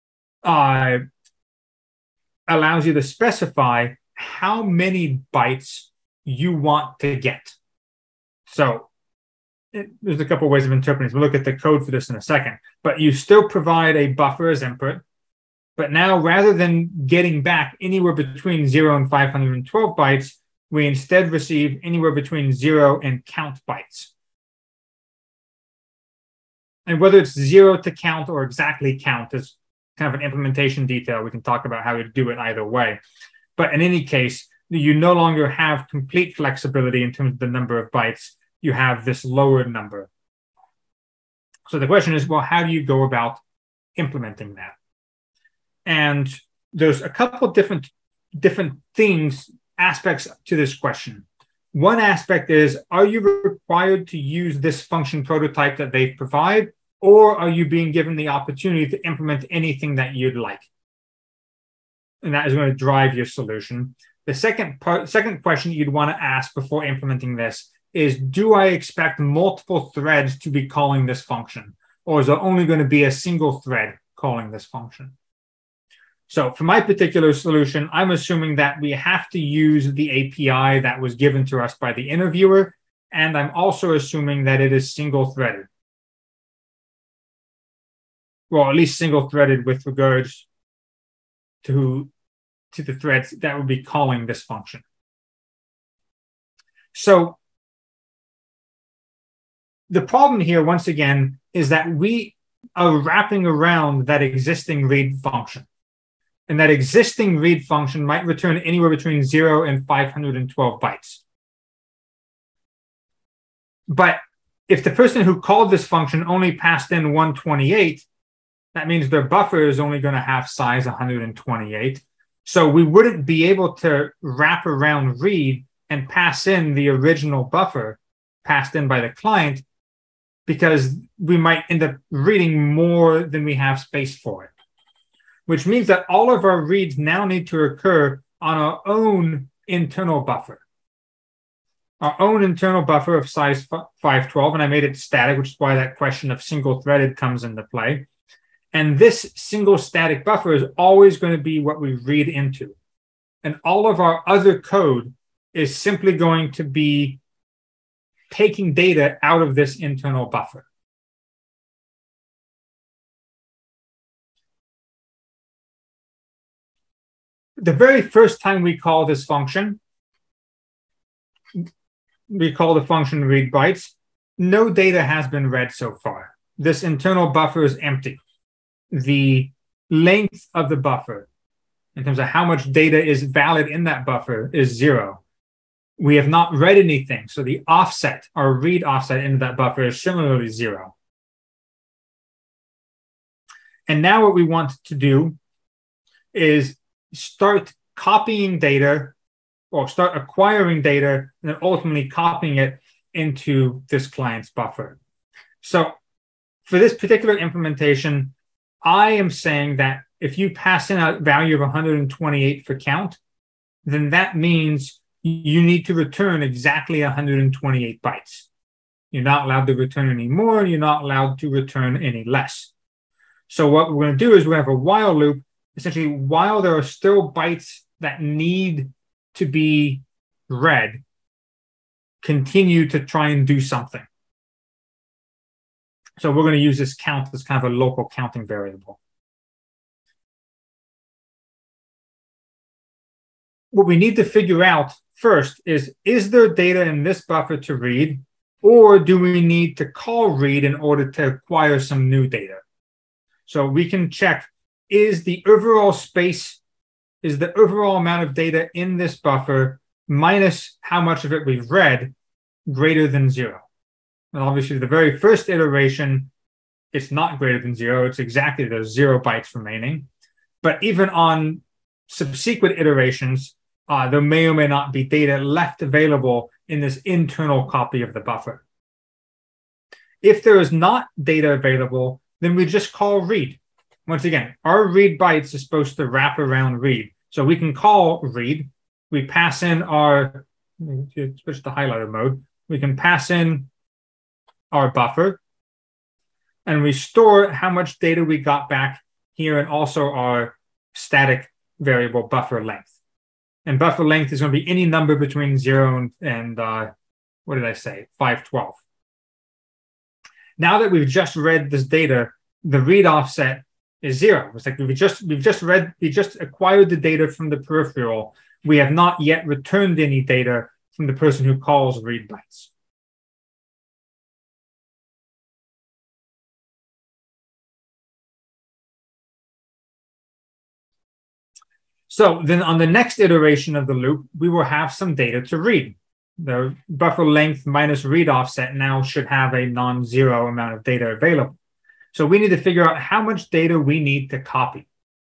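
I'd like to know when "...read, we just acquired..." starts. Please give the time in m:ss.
5:15.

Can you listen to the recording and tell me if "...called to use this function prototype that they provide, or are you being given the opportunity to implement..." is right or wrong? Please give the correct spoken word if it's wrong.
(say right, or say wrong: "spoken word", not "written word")
wrong: "required", not "called".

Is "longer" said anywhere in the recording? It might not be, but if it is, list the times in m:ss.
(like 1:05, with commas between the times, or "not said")
0:35.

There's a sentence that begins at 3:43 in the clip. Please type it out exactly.
So what we're going to do is we have a while loop.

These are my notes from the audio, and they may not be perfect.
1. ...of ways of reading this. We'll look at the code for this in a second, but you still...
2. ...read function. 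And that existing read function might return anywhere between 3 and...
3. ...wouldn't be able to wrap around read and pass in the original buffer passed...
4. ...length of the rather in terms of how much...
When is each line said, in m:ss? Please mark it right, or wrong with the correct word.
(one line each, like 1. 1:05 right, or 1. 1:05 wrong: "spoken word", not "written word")
1. 0:10 wrong: "interpreting", not "reading"
2. 1:44 wrong: "0", not "3"
3. 2:02 right
4. 2:59 wrong: "buffer", not "rather".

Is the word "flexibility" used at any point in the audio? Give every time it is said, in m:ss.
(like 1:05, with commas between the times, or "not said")
0:36.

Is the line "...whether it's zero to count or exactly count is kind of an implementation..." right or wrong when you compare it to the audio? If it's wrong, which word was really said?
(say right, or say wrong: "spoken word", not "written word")
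right.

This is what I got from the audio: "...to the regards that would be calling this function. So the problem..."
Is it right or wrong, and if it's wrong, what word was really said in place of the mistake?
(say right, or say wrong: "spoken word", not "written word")
wrong: "threads", not "regards".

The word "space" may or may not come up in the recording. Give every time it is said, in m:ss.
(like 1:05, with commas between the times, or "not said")
2:13, 4:15.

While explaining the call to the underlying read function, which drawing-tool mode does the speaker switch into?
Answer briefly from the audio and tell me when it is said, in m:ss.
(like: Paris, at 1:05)
highlighter mode, at 4:51.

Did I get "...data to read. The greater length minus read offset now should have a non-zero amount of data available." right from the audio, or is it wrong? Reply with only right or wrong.
wrong.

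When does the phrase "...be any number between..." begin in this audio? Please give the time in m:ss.
5:04.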